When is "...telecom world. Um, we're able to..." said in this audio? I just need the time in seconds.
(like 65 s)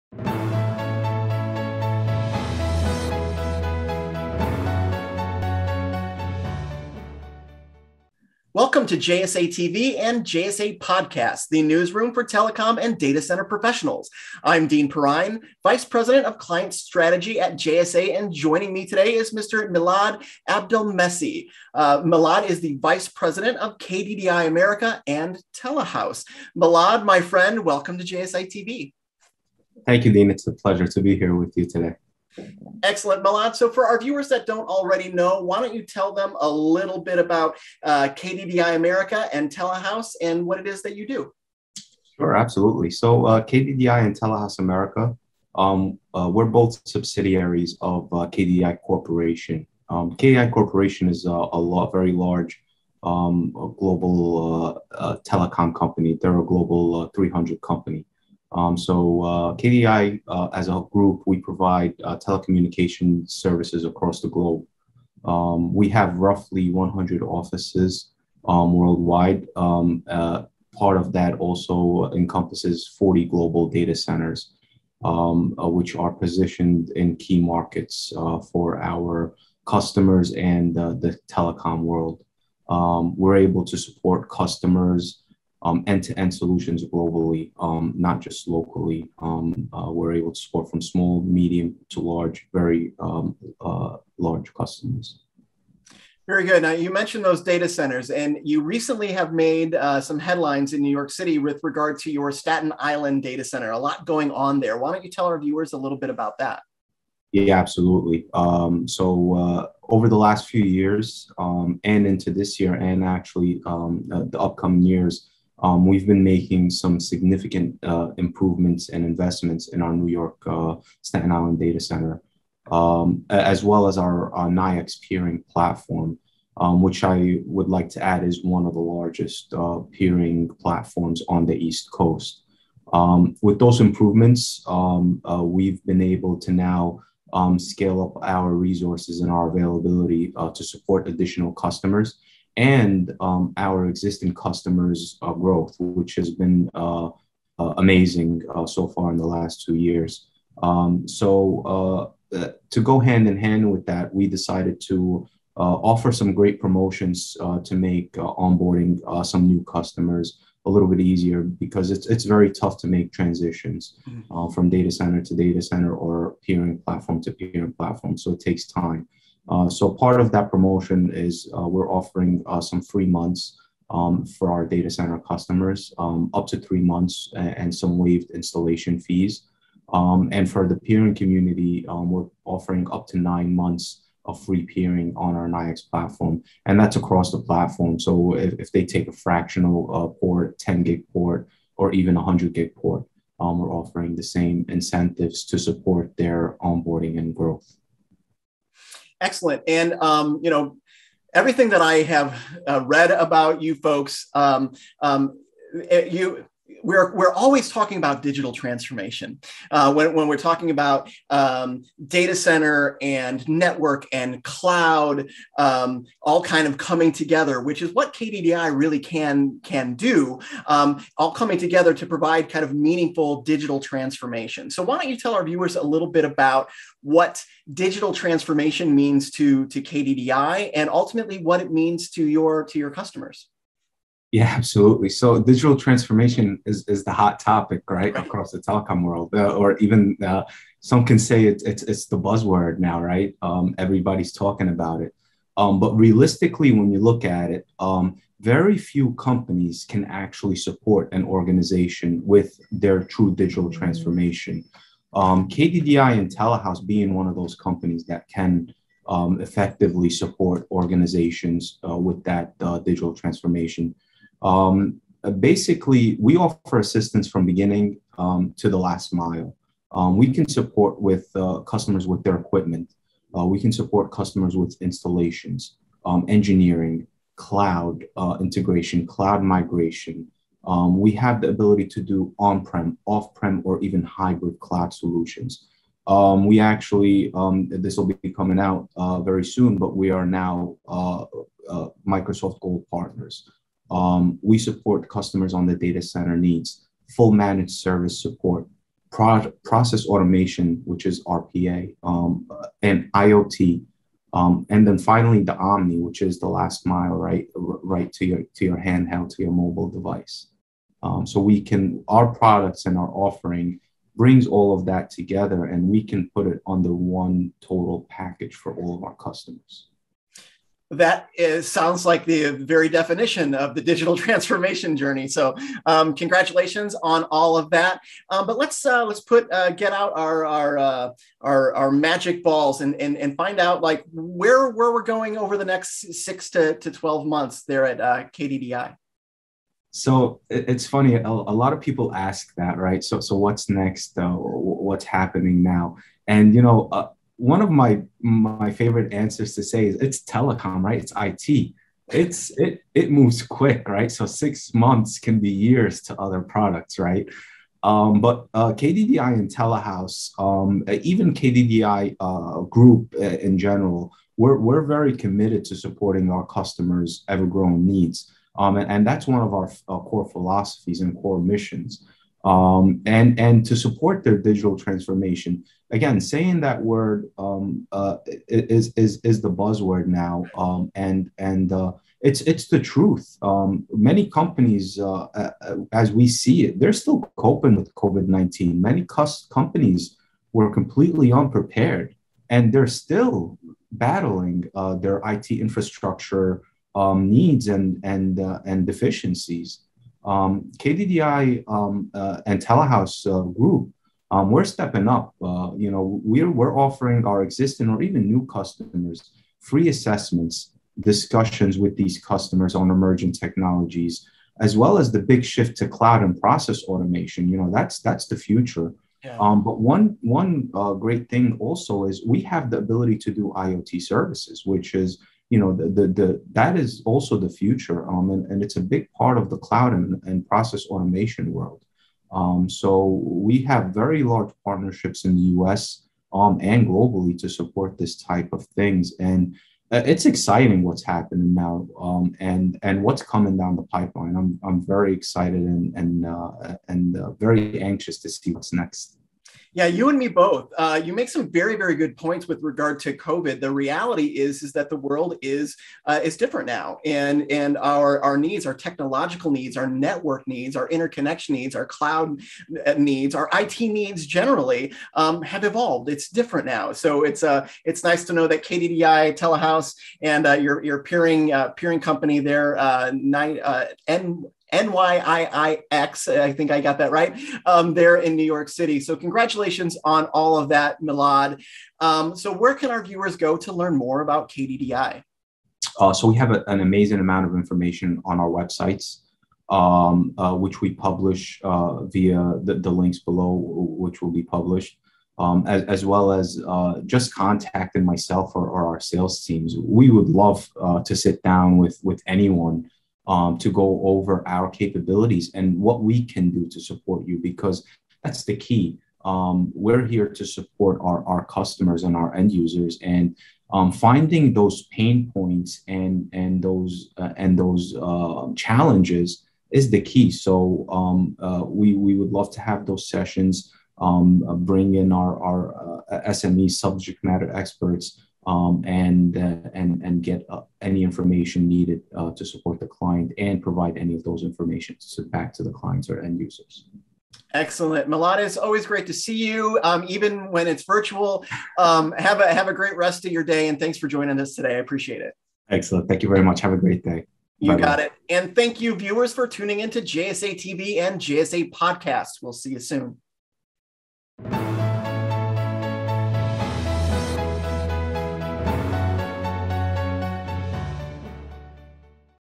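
81 s.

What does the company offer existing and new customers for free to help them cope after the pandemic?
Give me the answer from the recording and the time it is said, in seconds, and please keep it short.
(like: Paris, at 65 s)
Assessments, at 409 s.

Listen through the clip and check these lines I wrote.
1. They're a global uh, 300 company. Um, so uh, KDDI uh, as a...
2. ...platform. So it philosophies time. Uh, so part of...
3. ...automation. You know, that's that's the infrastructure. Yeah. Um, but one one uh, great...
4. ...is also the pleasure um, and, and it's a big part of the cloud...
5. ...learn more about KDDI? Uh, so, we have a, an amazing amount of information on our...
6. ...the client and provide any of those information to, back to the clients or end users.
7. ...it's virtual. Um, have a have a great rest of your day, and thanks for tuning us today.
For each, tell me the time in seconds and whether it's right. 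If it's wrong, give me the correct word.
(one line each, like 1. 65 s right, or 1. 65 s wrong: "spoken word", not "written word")
1. 56 s right
2. 167 s wrong: "takes", not "philosophies"
3. 416 s wrong: "future", not "infrastructure"
4. 426 s wrong: "future", not "pleasure"
5. 483 s right
6. 532 s right
7. 540 s wrong: "joining", not "tuning".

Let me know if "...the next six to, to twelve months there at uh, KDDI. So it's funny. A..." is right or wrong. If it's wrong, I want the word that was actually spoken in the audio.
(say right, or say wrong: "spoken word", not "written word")
right.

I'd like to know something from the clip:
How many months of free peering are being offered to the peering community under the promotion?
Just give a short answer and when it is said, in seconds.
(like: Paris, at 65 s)
9, at 183 s.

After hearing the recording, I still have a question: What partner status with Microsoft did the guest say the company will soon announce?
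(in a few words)
Gold partners.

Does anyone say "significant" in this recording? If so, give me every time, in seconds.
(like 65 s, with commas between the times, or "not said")
116 s.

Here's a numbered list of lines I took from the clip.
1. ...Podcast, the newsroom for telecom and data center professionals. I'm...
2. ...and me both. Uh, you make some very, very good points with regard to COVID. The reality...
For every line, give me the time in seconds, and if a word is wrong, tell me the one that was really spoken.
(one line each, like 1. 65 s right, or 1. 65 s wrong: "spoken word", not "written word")
1. 10 s right
2. 450 s right.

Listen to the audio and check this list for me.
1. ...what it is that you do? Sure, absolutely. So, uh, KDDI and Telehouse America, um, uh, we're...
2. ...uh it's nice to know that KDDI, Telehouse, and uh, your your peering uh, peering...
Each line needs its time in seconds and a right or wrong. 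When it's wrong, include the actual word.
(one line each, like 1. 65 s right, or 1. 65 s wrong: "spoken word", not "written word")
1. 40 s right
2. 467 s right.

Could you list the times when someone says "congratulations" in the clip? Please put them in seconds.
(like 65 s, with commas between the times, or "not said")
326 s, 479 s.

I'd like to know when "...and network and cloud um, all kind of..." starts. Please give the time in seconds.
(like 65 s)
213 s.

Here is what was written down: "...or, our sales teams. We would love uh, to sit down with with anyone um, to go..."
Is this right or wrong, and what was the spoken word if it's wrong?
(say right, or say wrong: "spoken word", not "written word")
right.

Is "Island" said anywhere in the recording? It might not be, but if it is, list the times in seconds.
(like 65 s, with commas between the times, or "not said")
102 s, 121 s.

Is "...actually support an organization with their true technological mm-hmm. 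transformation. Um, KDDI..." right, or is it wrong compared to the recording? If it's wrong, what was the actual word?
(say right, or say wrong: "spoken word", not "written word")
wrong: "digital", not "technological".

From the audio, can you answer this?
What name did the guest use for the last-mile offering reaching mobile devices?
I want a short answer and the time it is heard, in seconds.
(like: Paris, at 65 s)
Omni, at 305 s.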